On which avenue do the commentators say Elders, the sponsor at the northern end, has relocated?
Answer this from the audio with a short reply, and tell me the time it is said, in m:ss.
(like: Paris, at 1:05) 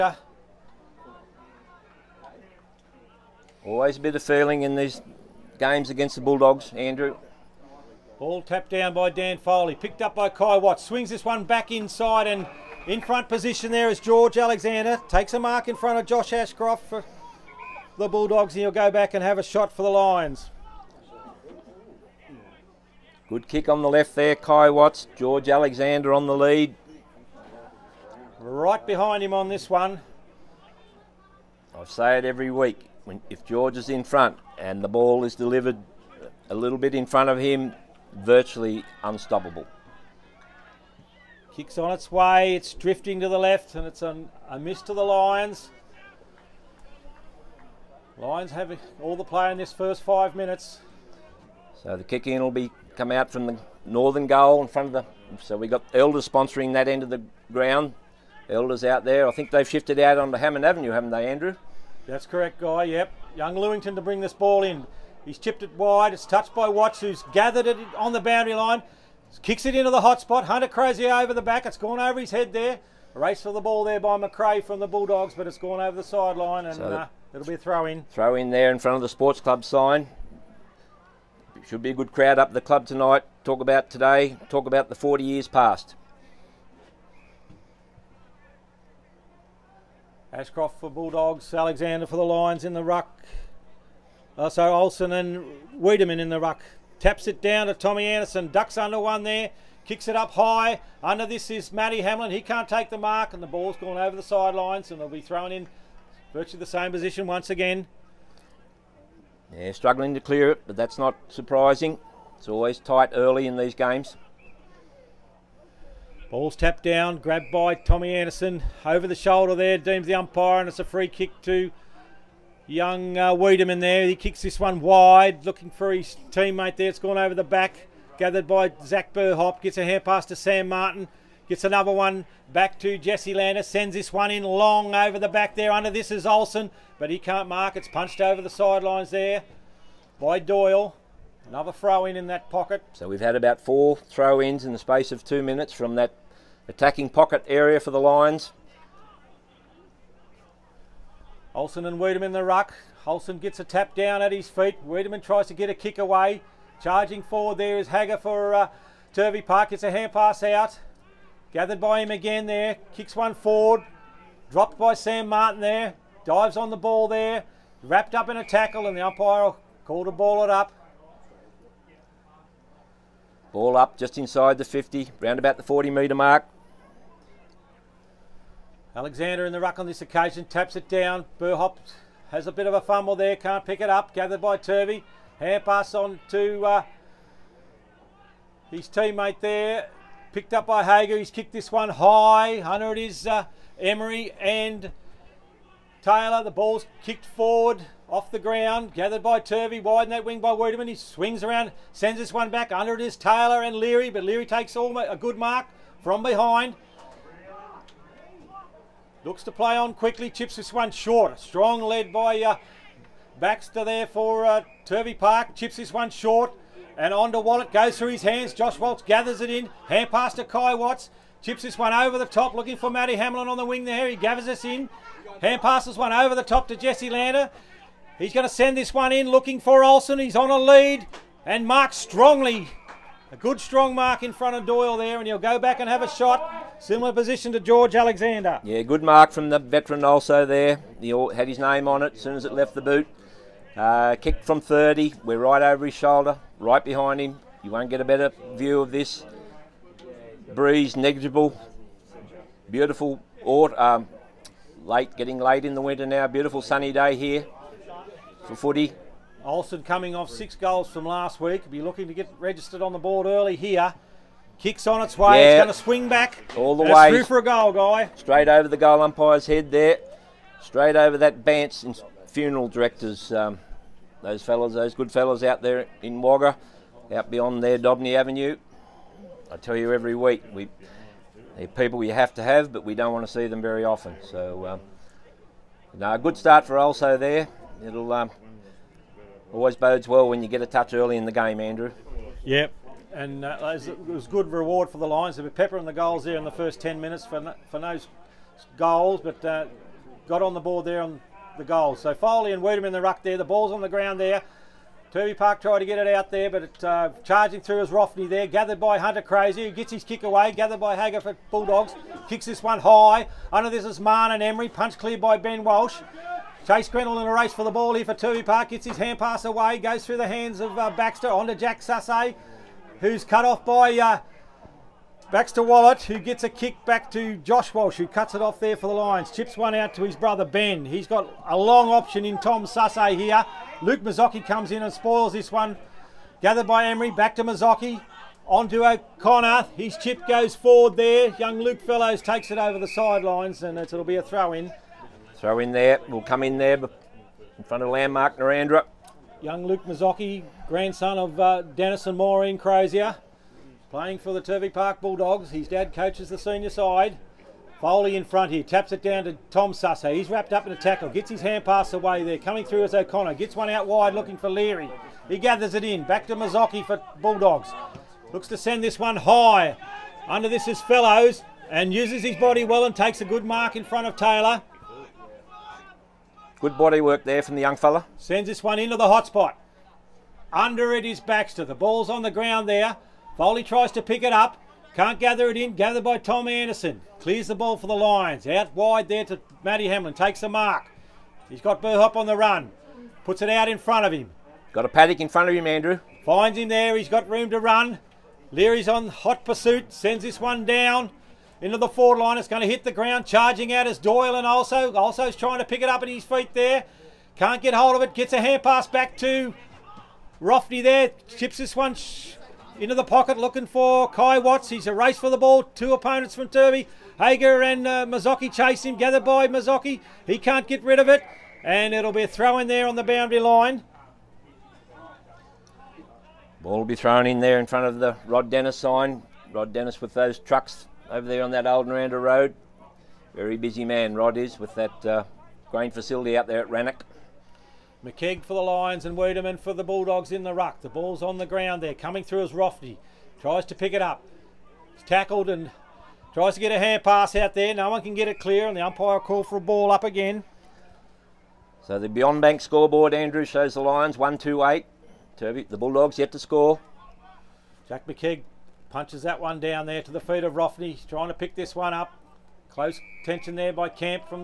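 Hammond Avenue, at 1:00.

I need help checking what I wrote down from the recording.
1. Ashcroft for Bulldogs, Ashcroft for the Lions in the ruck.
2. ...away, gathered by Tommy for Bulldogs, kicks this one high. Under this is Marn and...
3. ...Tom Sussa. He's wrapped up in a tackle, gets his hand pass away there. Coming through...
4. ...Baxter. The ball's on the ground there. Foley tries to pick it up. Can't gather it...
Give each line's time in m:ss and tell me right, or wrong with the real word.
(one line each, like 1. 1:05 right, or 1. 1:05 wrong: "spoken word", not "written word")
1. 1:30 wrong: "Alexander", not "Ashcroft"
2. 5:10 wrong: "Hagger", not "Tommy"
3. 5:59 right
4. 6:21 right.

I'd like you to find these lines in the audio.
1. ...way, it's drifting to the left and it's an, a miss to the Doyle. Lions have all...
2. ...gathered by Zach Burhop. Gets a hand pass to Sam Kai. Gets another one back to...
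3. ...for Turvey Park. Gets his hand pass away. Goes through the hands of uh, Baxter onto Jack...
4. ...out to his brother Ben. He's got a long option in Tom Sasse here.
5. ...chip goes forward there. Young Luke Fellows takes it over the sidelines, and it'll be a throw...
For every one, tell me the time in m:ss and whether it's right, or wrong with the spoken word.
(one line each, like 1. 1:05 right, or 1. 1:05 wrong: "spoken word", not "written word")
1. 0:42 wrong: "Lions", not "Doyle"
2. 2:08 wrong: "Martin", not "Kai"
3. 5:18 right
4. 5:29 right
5. 5:39 right.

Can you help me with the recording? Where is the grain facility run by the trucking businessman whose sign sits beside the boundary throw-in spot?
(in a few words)
Rannoch.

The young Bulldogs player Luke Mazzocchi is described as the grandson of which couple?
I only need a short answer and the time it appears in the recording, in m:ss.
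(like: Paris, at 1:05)
Dennis and Maureen Crozier, at 5:51.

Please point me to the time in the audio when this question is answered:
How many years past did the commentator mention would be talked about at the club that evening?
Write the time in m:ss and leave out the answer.
1:24.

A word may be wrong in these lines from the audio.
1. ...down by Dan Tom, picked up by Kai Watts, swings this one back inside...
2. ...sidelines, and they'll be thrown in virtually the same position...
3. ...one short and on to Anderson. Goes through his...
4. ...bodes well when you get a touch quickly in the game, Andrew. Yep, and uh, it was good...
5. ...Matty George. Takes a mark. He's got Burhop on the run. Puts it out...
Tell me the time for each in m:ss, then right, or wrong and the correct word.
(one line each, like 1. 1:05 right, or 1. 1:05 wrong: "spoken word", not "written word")
1. 0:08 wrong: "Foley", not "Tom"
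2. 1:44 right
3. 3:35 wrong: "Wallet", not "Anderson"
4. 4:49 wrong: "early", not "quickly"
5. 6:29 wrong: "Hamlin", not "George".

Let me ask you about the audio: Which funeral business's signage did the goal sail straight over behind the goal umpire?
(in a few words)
Bance.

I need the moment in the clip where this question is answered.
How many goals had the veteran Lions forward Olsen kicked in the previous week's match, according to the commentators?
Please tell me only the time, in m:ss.
4:20.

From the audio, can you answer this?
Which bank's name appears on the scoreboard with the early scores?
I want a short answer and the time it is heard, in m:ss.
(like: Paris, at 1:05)
Beyond Bank, at 7:32.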